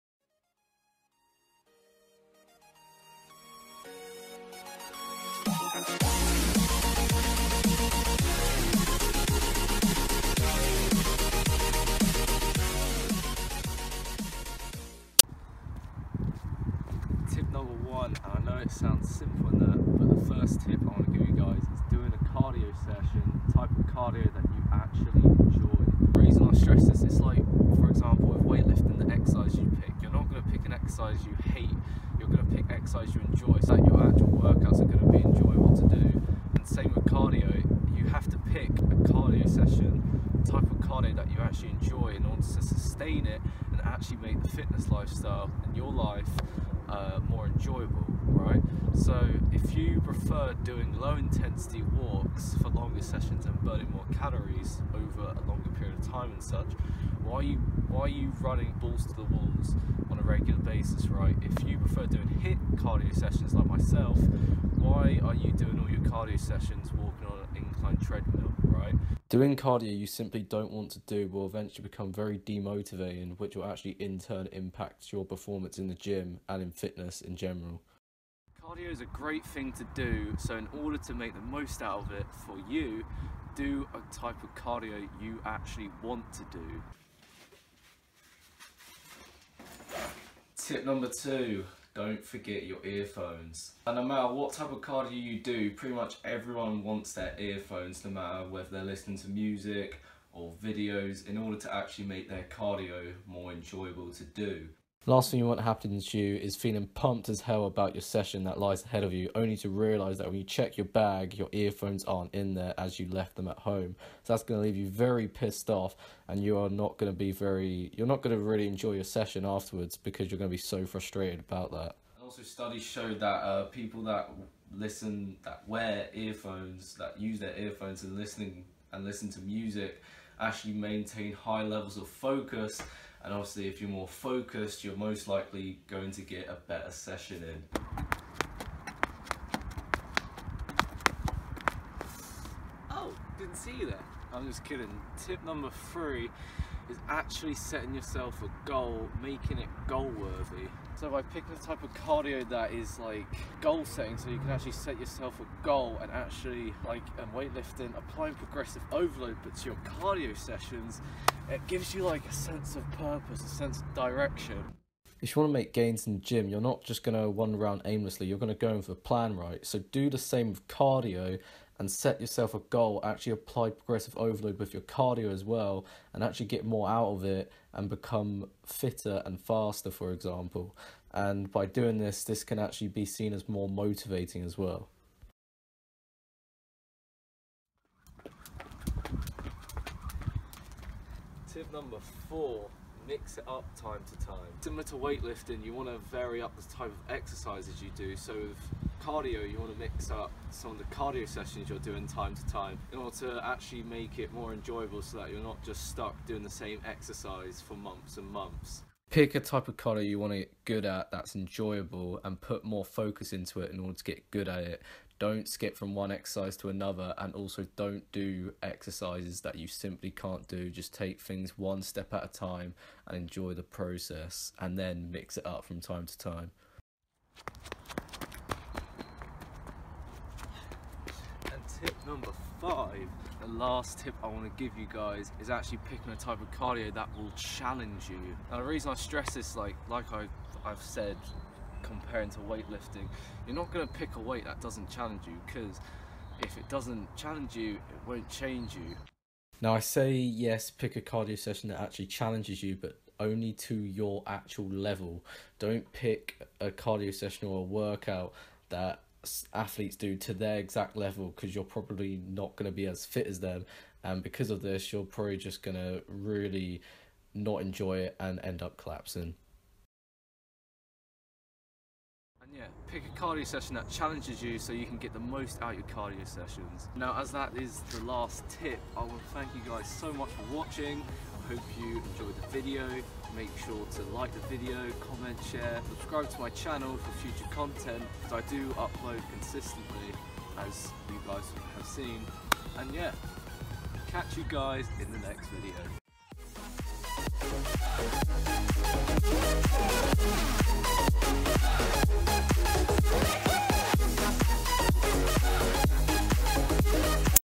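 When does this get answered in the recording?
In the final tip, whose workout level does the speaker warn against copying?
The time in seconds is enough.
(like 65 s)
259 s.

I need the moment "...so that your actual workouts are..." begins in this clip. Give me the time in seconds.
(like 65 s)
33 s.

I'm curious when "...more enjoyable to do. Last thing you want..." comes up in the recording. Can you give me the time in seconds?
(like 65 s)
103 s.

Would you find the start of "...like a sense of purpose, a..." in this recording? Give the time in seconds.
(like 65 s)
162 s.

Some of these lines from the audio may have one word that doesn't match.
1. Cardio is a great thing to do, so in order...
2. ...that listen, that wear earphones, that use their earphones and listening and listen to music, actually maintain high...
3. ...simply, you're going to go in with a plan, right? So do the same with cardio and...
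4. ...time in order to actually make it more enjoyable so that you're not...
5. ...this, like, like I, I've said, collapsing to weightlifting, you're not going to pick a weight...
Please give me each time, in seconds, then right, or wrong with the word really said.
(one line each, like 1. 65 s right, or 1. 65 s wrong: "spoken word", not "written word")
1. 78 s right
2. 124 s right
3. 167 s wrong: "aimlessly", not "simply"
4. 202 s right
5. 239 s wrong: "comparing", not "collapsing".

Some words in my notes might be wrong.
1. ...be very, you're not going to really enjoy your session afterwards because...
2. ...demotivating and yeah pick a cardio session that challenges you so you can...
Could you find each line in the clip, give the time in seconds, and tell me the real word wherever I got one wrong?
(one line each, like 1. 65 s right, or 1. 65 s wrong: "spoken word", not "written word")
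1. 117 s right
2. 268 s wrong: "collapsing", not "demotivating".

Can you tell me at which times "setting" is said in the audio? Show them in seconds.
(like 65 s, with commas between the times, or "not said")
147 s, 153 s.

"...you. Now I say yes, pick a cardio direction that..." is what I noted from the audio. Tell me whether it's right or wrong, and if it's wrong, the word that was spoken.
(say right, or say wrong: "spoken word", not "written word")
wrong: "session", not "direction".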